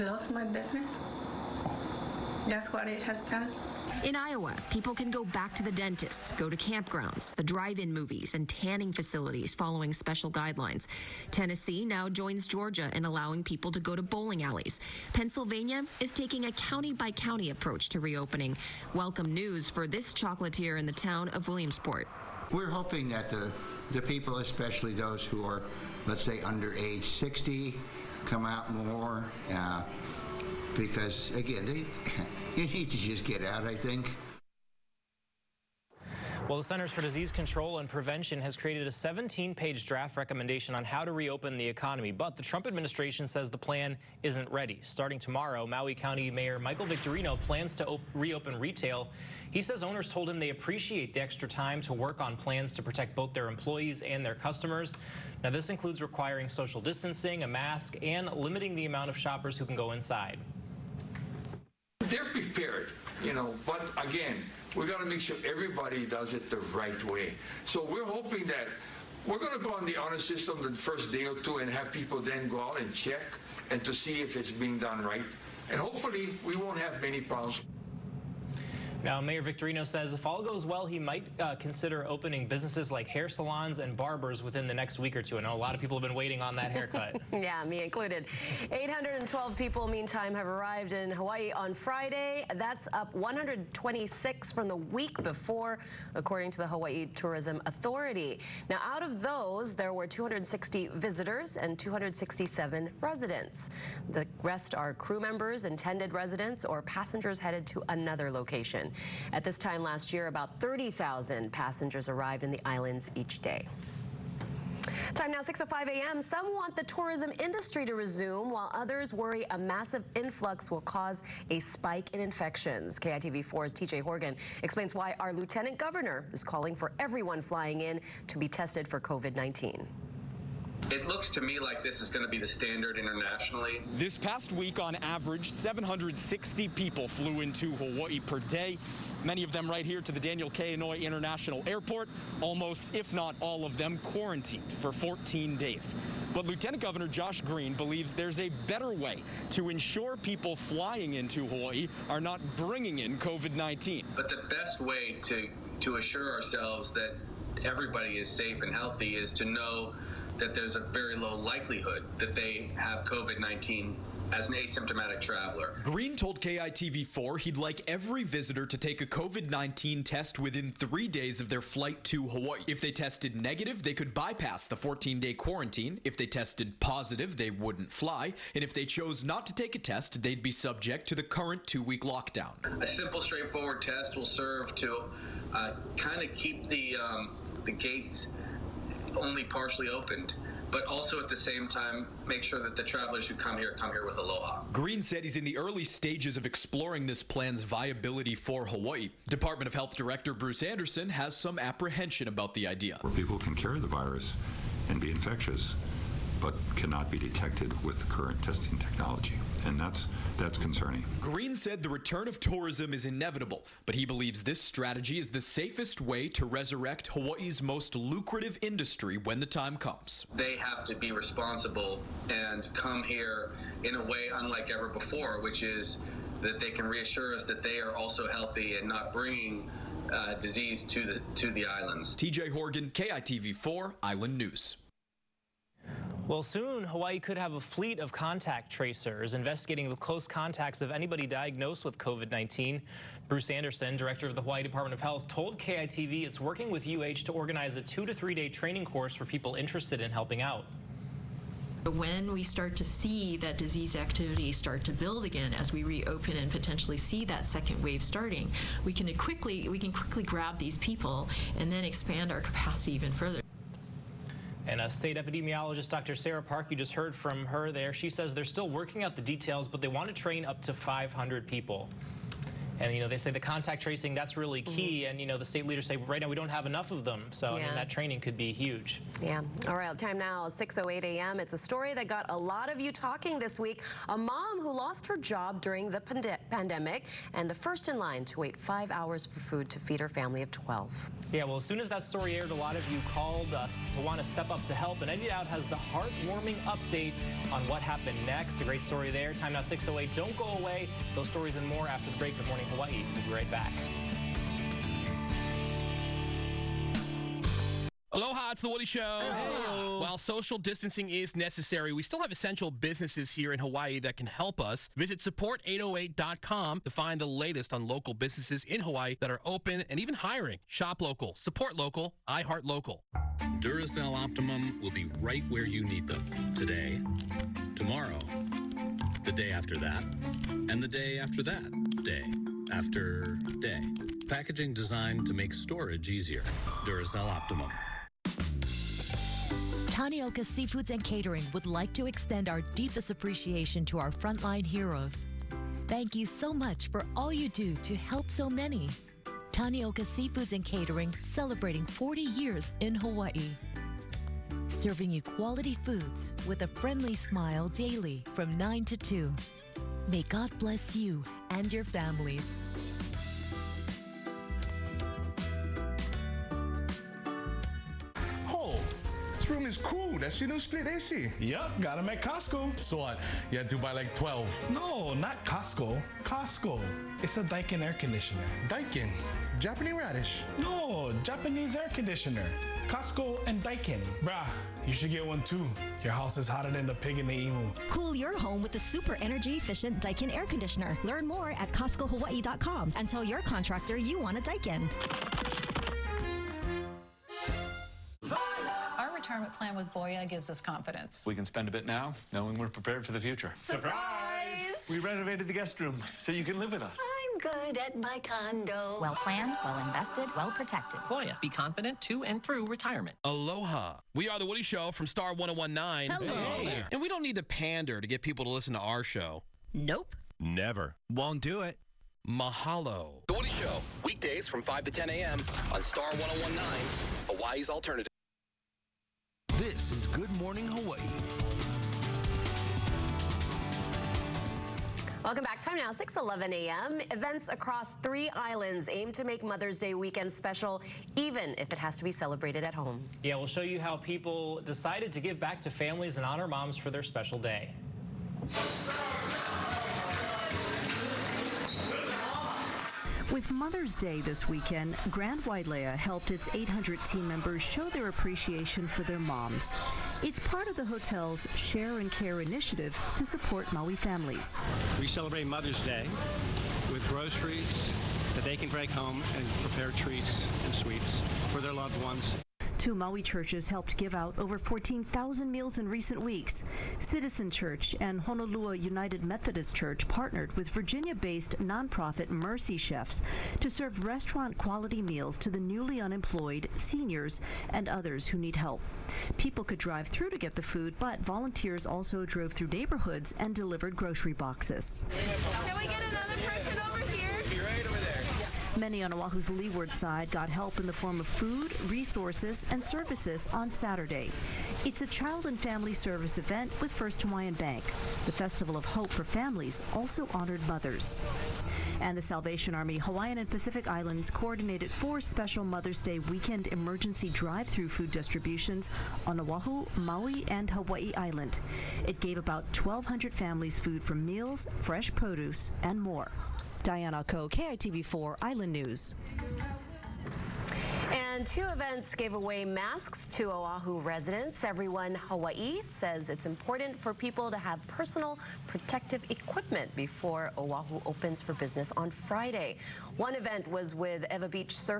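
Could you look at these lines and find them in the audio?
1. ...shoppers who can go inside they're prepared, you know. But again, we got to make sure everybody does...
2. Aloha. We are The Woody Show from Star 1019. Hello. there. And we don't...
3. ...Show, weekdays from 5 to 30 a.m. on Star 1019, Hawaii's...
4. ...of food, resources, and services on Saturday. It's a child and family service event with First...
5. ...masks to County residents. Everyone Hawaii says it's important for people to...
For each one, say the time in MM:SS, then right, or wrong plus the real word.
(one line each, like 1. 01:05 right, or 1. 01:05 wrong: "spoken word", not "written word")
1. 00:59 right
2. 06:53 right
3. 07:03 wrong: "10", not "30"
4. 08:21 right
5. 08:52 wrong: "Oahu", not "County".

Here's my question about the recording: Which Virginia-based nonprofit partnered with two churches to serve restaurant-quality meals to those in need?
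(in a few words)
Mercy Chefs.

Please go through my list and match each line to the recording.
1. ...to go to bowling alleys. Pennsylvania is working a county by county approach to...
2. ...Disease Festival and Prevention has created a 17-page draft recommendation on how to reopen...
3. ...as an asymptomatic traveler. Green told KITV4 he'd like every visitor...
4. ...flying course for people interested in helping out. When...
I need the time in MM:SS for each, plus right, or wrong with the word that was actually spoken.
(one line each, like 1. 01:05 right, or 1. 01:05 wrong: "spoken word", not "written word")
1. 00:13 wrong: "taking", not "working"
2. 00:37 wrong: "Control", not "Festival"
3. 02:44 right
4. 04:08 wrong: "training", not "flying".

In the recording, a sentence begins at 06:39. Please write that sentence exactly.
retirement plan with Voya gives us confidence.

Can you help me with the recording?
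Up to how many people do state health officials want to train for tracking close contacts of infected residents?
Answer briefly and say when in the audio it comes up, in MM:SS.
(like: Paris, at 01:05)
500, at 04:30.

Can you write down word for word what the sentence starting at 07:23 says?
Yeah, we'll show you how people decided to give back to families and honor moms for their special day.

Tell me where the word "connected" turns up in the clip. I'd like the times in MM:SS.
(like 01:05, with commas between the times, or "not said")
not said.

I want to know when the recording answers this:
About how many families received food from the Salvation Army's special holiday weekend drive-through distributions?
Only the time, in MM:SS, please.
08:42.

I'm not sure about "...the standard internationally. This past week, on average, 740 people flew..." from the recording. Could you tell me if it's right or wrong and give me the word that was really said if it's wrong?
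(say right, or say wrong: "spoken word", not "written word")
wrong: "760", not "740".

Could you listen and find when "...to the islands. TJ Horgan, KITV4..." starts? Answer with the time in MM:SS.
03:51.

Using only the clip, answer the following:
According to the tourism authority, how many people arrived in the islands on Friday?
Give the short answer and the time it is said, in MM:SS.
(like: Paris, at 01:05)
812, at 01:28.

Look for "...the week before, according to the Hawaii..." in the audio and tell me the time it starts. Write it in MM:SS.
01:34.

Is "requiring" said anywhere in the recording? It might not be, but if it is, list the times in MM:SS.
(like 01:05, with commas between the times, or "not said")
00:56.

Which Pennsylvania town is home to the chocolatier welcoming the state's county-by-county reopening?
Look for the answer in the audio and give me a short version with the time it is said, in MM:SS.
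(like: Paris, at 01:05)
Williamsport, at 00:21.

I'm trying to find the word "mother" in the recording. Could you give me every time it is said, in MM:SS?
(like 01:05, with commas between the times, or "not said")
07:19, 07:33, 07:45, 08:30, 08:35.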